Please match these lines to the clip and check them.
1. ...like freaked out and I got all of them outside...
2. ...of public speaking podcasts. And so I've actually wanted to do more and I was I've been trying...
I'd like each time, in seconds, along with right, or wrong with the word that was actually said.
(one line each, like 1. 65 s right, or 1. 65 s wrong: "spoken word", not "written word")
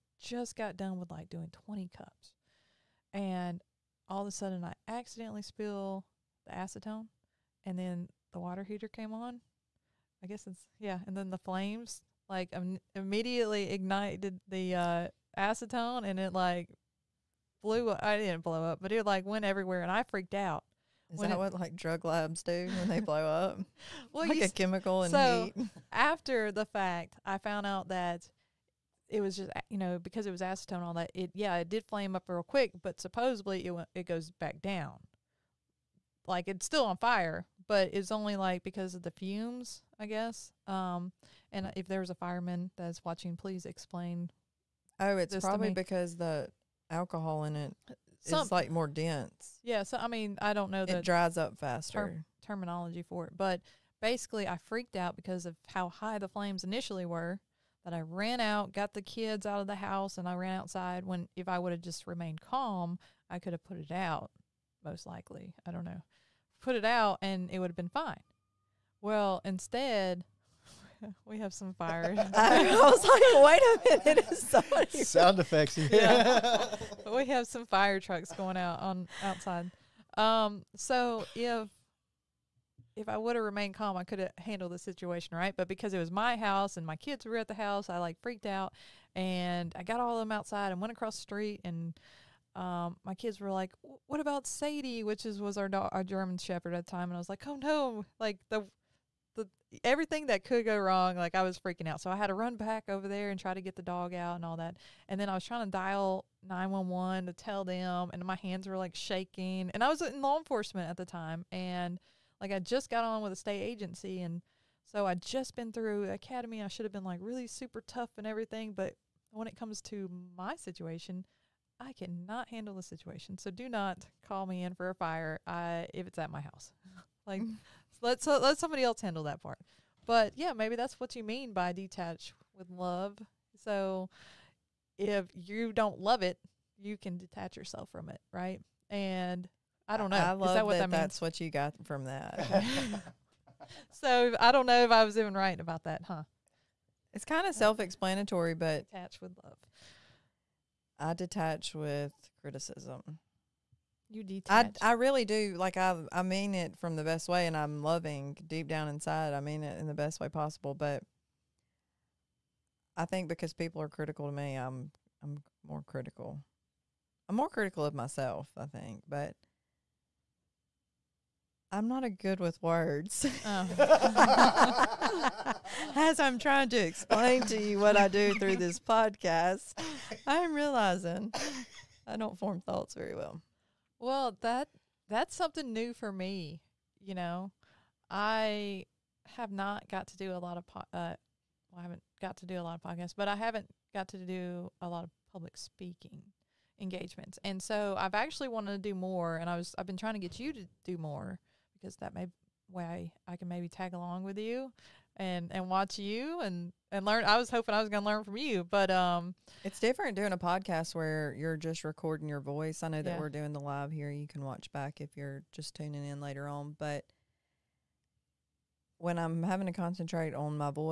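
1. 87 s right
2. 195 s wrong: "engagements", not "podcasts".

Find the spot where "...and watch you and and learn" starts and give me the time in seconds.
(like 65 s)
205 s.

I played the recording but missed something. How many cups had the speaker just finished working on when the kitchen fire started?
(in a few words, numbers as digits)
20.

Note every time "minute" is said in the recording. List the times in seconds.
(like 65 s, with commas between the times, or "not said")
74 s.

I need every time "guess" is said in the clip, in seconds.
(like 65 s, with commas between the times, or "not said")
10 s, 40 s.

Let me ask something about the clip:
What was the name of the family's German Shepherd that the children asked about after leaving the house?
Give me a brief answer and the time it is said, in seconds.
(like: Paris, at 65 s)
Sadie, at 94 s.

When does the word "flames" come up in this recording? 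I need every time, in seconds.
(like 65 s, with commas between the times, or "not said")
11 s, 31 s, 56 s.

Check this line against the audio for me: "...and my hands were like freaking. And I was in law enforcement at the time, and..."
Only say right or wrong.
wrong.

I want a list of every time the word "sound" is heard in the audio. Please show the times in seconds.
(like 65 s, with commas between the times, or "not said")
75 s.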